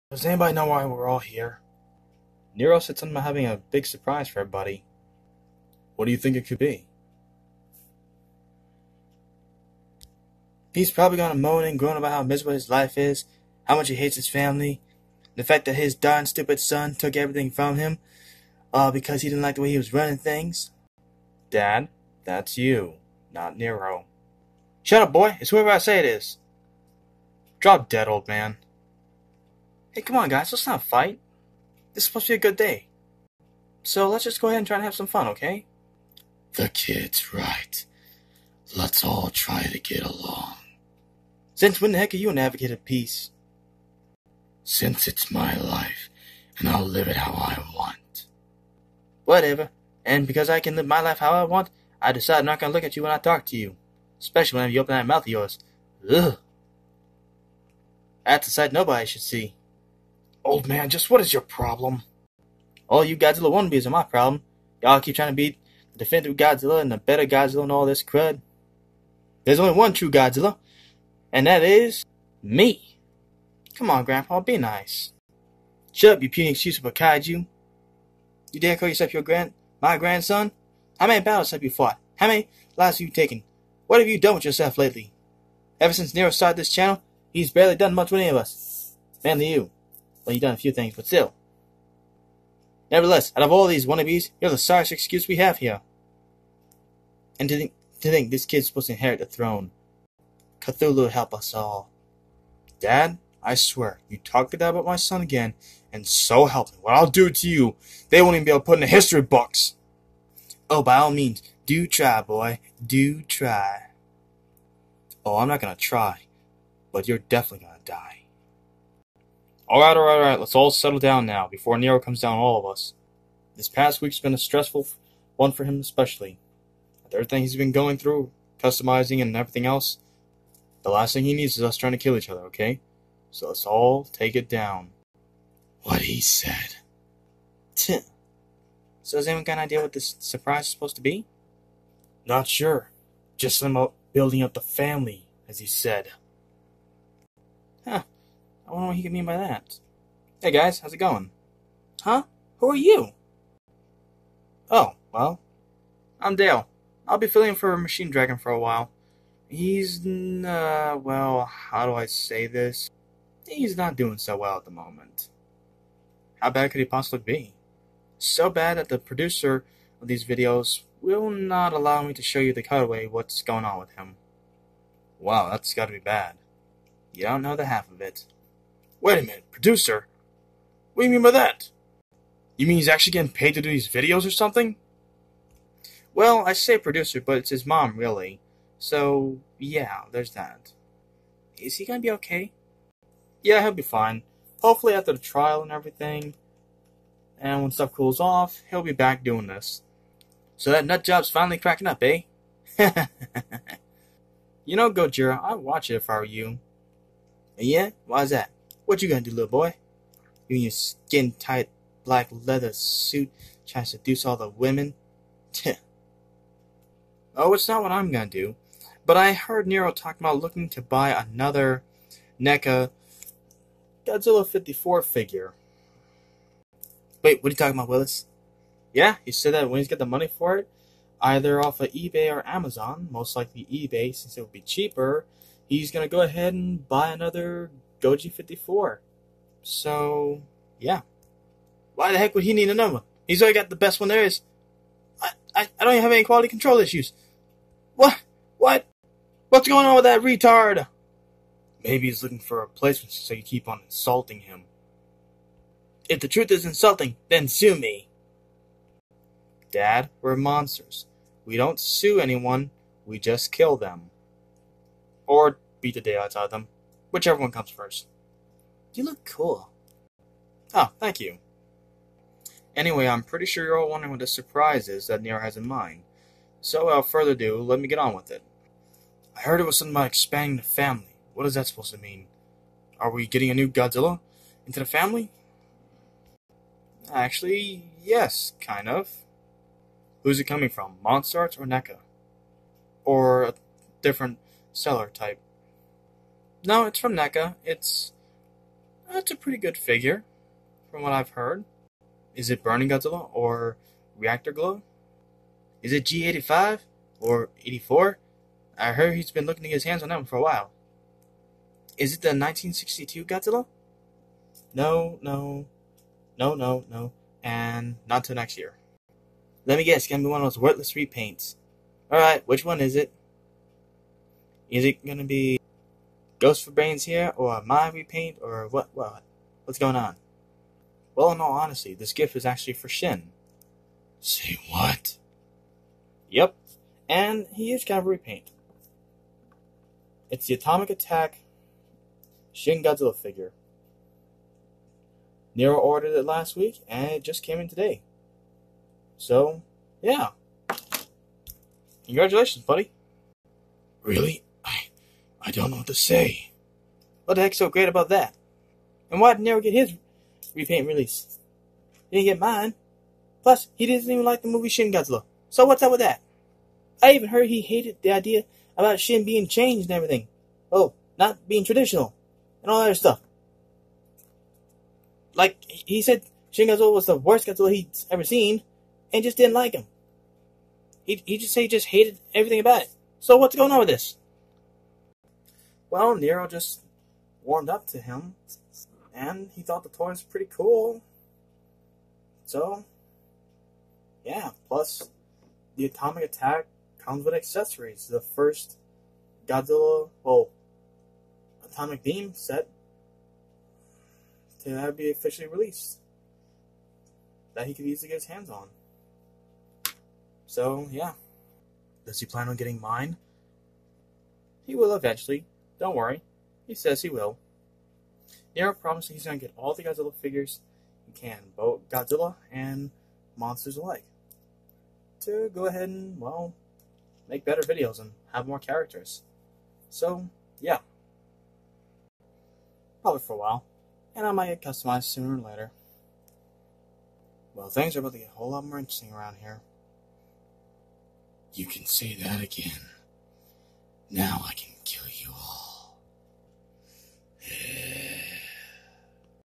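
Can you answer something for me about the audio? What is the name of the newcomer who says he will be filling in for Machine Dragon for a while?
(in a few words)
Dale.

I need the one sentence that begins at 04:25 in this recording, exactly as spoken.
Or beat the daylights out of them whichever one comes first.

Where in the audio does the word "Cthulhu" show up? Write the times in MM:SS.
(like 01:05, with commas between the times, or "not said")
01:40.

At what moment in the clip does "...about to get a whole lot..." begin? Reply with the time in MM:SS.
07:18.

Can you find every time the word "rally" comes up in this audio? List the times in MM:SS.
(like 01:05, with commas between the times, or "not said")
not said.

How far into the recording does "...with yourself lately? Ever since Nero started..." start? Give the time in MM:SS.
01:24.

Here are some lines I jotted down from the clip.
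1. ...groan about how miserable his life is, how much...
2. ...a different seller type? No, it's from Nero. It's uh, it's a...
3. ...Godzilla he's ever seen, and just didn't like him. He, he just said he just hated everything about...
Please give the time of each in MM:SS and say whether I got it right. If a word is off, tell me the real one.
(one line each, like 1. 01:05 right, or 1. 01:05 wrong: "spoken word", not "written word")
1. 00:11 right
2. 04:53 wrong: "NECA", not "Nero"
3. 06:17 right.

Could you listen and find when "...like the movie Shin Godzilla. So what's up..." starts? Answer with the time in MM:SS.
06:04.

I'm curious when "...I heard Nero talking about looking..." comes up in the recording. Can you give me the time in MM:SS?
03:39.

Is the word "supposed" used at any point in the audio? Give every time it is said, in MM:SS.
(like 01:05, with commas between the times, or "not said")
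00:32, 01:38, 02:20, 04:41.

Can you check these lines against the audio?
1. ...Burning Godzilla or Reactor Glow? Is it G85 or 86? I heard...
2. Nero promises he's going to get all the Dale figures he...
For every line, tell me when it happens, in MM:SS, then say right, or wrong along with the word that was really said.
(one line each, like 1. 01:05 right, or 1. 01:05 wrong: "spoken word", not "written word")
1. 05:02 wrong: "84", not "86"
2. 06:58 wrong: "Godzilla", not "Dale".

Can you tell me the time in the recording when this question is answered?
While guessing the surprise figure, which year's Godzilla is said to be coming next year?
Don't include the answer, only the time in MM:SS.
05:12.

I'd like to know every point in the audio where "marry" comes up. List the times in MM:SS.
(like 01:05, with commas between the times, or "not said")
not said.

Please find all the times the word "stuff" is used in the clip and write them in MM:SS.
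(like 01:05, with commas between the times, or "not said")
03:17, 06:12.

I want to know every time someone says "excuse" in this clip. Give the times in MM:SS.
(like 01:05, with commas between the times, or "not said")
01:16, 01:34.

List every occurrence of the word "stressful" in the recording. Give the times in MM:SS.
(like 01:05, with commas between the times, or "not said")
02:04.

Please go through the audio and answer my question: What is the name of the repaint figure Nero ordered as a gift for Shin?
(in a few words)
Atomic Attack Shin Godzilla.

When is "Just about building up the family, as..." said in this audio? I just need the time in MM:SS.
02:23.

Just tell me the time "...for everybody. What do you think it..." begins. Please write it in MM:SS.
00:04.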